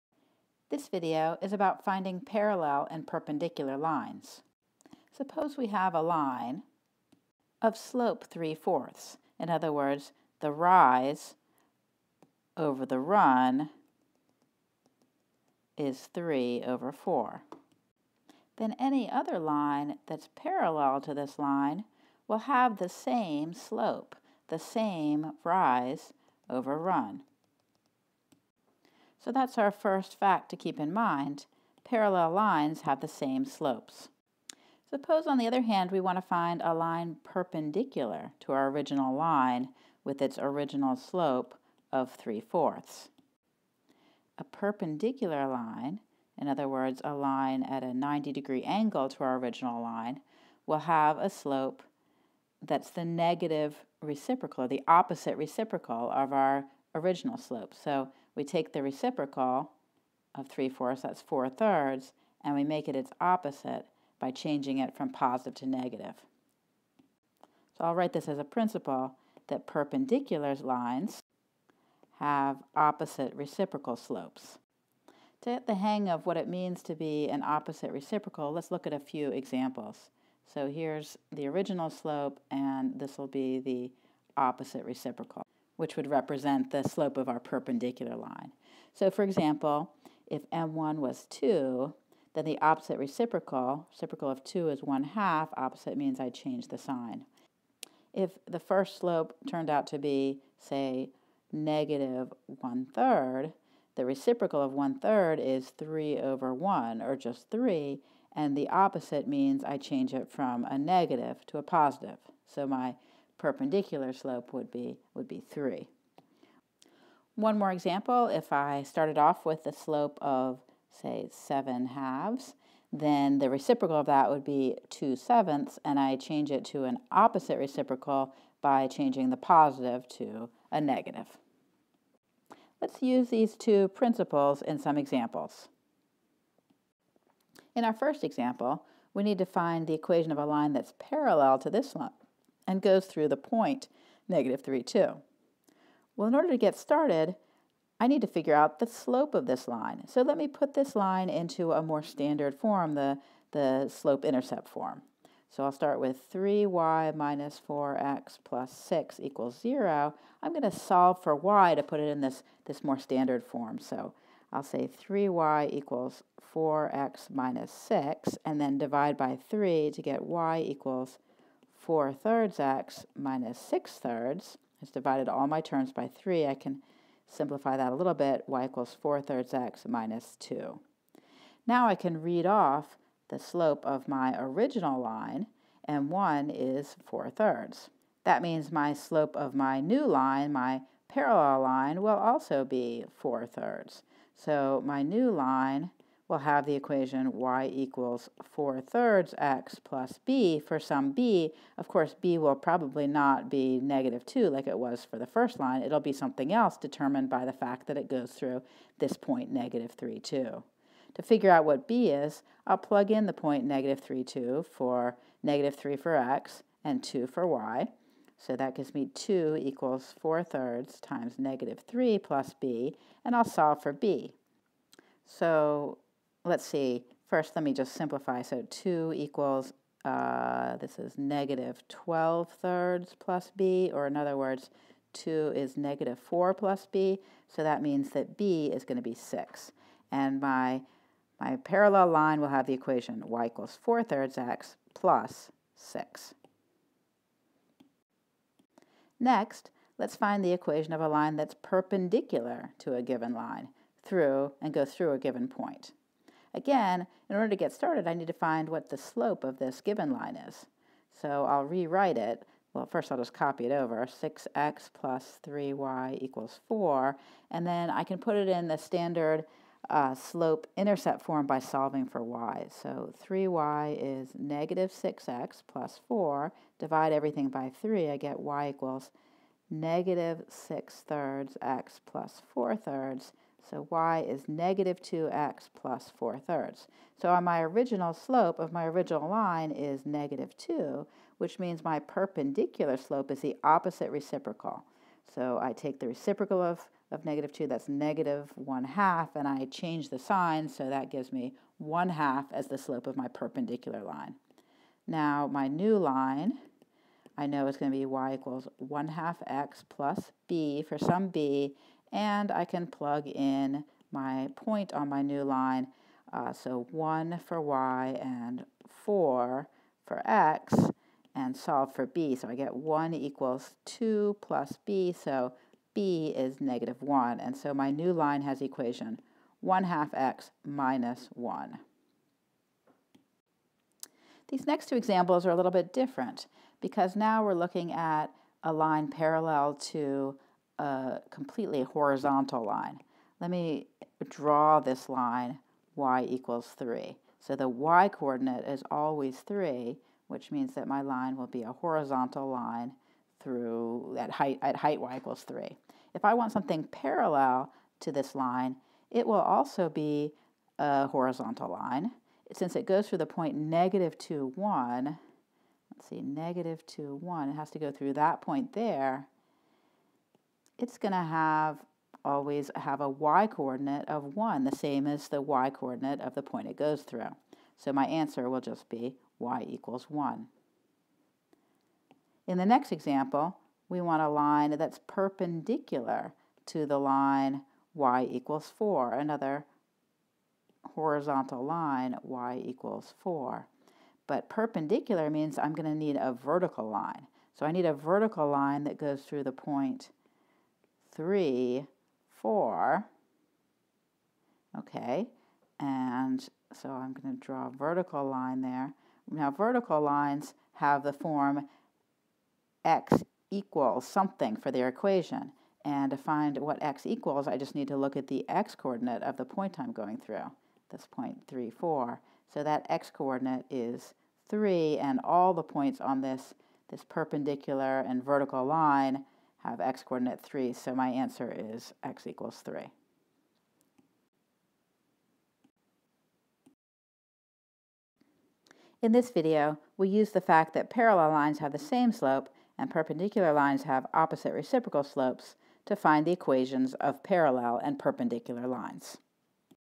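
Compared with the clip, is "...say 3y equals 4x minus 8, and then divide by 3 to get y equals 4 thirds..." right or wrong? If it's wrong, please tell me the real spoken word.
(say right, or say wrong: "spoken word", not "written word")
wrong: "6", not "8".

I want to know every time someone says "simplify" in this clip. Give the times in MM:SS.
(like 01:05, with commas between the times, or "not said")
02:57, 03:47.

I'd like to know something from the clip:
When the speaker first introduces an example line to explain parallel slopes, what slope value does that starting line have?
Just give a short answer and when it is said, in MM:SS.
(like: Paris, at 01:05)
3/4, at 00:40.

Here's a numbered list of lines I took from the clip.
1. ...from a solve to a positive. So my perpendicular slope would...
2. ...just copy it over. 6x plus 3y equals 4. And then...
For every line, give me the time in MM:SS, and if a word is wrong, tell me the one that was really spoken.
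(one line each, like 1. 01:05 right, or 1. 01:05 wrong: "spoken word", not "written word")
1. 01:50 wrong: "negative", not "solve"
2. 04:23 right.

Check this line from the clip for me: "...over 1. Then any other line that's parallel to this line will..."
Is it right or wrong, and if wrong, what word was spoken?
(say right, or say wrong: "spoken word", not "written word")
wrong: "4", not "1".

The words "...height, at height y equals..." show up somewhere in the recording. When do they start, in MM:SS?
05:54.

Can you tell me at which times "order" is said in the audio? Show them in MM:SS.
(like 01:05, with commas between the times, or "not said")
02:26, 04:17.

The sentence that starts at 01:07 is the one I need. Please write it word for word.
So I'll write this as a principle that perpendicular lines have opposite reciprocal slopes.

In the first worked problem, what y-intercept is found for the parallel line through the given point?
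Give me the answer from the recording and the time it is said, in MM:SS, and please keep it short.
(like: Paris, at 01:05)
6, at 03:58.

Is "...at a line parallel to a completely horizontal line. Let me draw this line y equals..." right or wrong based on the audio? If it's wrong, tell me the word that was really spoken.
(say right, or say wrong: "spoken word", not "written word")
right.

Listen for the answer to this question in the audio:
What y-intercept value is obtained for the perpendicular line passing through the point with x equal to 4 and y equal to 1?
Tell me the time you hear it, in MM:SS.
05:25.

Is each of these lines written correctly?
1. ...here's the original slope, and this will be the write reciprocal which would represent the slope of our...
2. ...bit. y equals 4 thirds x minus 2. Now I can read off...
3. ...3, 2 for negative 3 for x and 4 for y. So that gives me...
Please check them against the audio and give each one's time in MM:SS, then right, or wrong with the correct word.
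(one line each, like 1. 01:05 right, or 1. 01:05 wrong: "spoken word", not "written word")
1. 01:20 wrong: "opposite", not "write"
2. 02:58 right
3. 03:33 wrong: "2", not "4".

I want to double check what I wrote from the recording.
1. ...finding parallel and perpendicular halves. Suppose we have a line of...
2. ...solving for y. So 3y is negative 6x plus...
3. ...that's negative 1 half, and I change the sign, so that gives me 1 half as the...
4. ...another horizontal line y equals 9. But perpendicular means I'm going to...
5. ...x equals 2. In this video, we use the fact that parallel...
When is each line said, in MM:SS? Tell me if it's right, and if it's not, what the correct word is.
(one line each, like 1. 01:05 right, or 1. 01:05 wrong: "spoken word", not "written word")
1. 00:01 wrong: "lines", not "halves"
2. 04:31 right
3. 04:57 right
4. 06:29 wrong: "4", not "9"
5. 07:12 wrong: "3", not "2".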